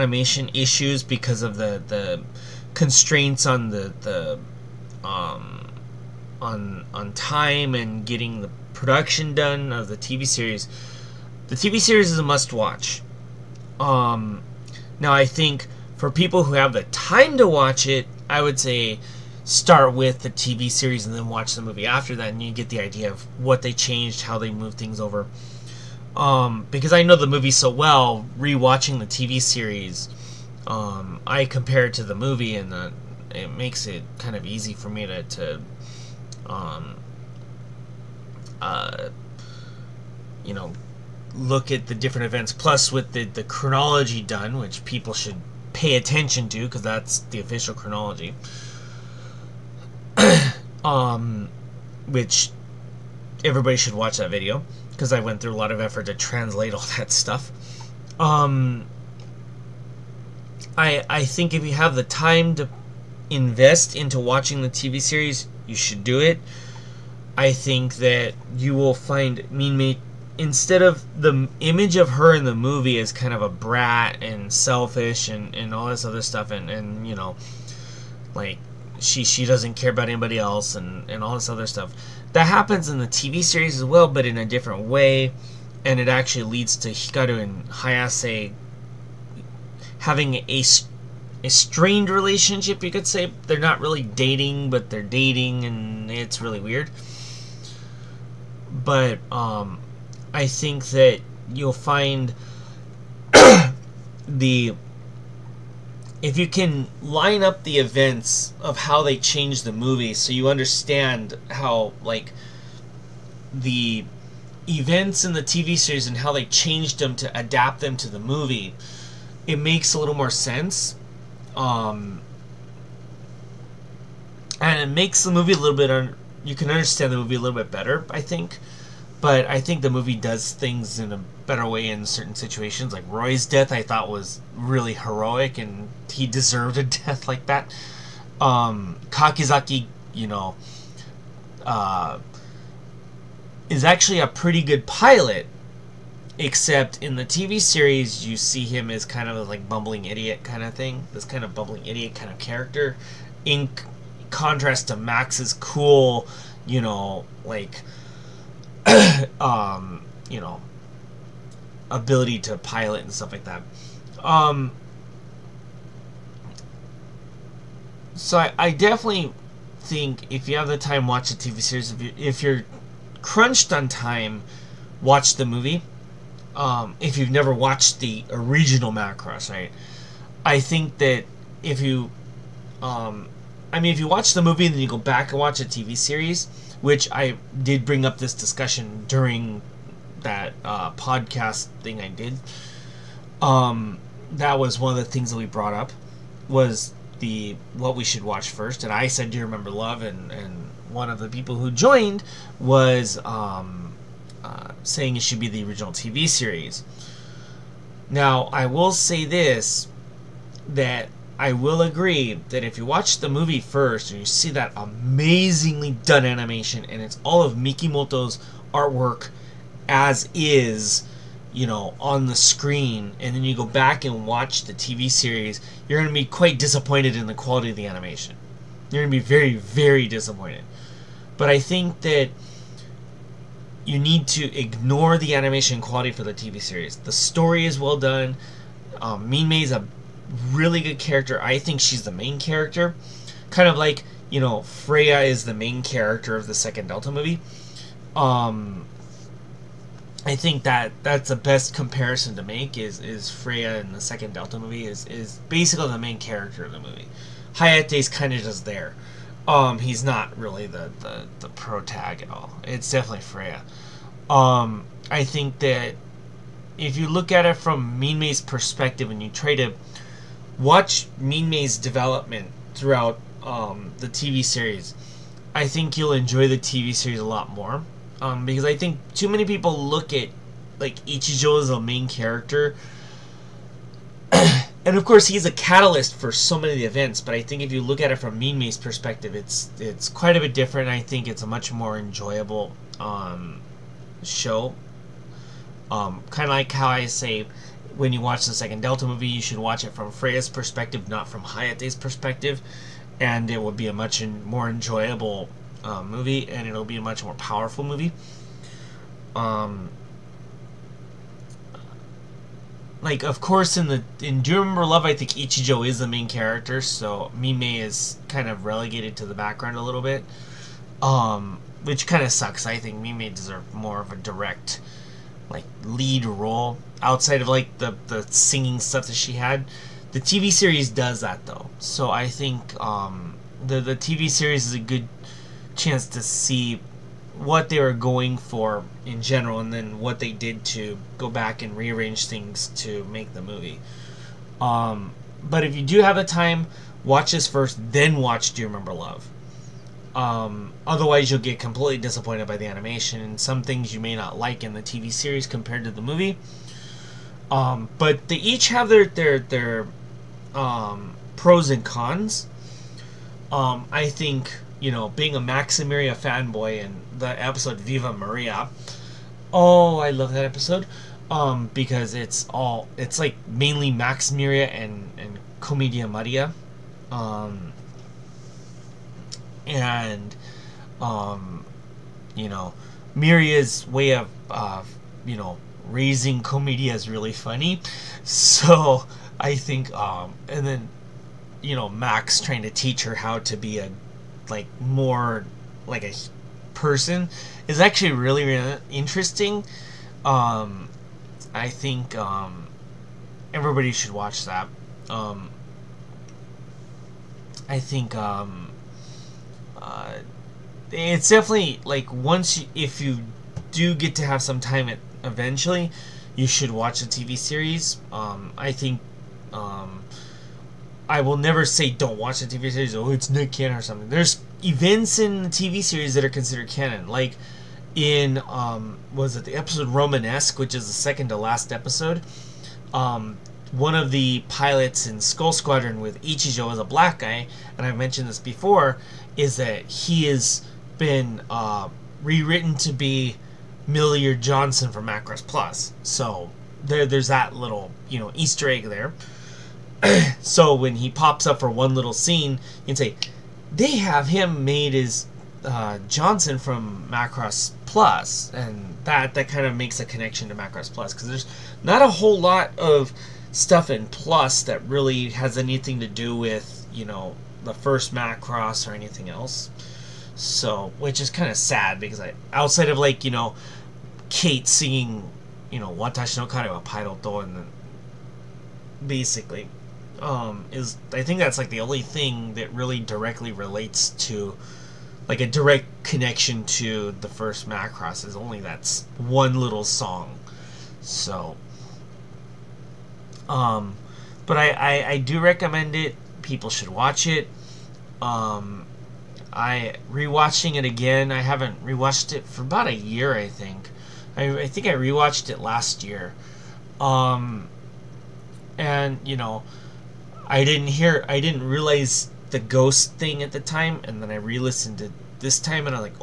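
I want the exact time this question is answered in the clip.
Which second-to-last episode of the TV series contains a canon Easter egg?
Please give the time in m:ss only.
7:09.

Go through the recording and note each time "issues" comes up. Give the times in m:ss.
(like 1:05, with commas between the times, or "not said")
0:00.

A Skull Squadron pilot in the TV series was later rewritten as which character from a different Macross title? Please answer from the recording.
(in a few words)
Milliard Johnson.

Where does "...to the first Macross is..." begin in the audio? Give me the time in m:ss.
8:06.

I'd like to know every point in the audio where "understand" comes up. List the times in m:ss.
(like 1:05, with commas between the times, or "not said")
1:50, 2:06.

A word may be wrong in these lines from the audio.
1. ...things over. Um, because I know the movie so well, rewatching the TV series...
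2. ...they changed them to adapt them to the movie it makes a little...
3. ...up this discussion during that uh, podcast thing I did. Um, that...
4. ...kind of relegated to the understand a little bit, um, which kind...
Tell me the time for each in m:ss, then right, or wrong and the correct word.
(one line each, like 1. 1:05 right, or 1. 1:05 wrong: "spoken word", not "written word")
1. 0:24 right
2. 1:56 right
3. 3:08 right
4. 5:18 wrong: "background", not "understand".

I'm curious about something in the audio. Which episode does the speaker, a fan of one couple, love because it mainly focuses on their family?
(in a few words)
Viva Maria.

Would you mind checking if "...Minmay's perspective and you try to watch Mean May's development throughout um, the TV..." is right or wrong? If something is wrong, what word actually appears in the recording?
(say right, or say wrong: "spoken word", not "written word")
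right.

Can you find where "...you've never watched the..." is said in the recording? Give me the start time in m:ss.
2:57.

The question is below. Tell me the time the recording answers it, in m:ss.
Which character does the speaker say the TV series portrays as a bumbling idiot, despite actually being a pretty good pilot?
2:19.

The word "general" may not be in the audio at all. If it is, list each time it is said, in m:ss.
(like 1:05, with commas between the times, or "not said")
5:39.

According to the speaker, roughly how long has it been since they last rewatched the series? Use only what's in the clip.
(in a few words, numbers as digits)
a year.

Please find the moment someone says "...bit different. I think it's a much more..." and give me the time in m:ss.
4:50.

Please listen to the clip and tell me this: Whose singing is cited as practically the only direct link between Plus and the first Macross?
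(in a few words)
Kate.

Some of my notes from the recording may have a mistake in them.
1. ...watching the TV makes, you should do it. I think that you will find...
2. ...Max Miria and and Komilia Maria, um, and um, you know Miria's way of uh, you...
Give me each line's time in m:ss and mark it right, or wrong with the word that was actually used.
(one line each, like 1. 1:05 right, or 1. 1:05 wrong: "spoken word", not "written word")
1. 1:04 wrong: "series", not "makes"
2. 6:13 right.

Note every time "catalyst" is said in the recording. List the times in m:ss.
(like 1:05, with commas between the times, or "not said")
4:45.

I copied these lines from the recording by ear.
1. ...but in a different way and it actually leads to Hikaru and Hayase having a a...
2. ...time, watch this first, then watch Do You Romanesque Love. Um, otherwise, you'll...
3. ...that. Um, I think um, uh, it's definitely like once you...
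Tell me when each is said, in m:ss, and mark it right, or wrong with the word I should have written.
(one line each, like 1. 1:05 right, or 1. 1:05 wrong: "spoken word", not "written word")
1. 1:24 right
2. 5:46 wrong: "Remember", not "Romanesque"
3. 6:44 right.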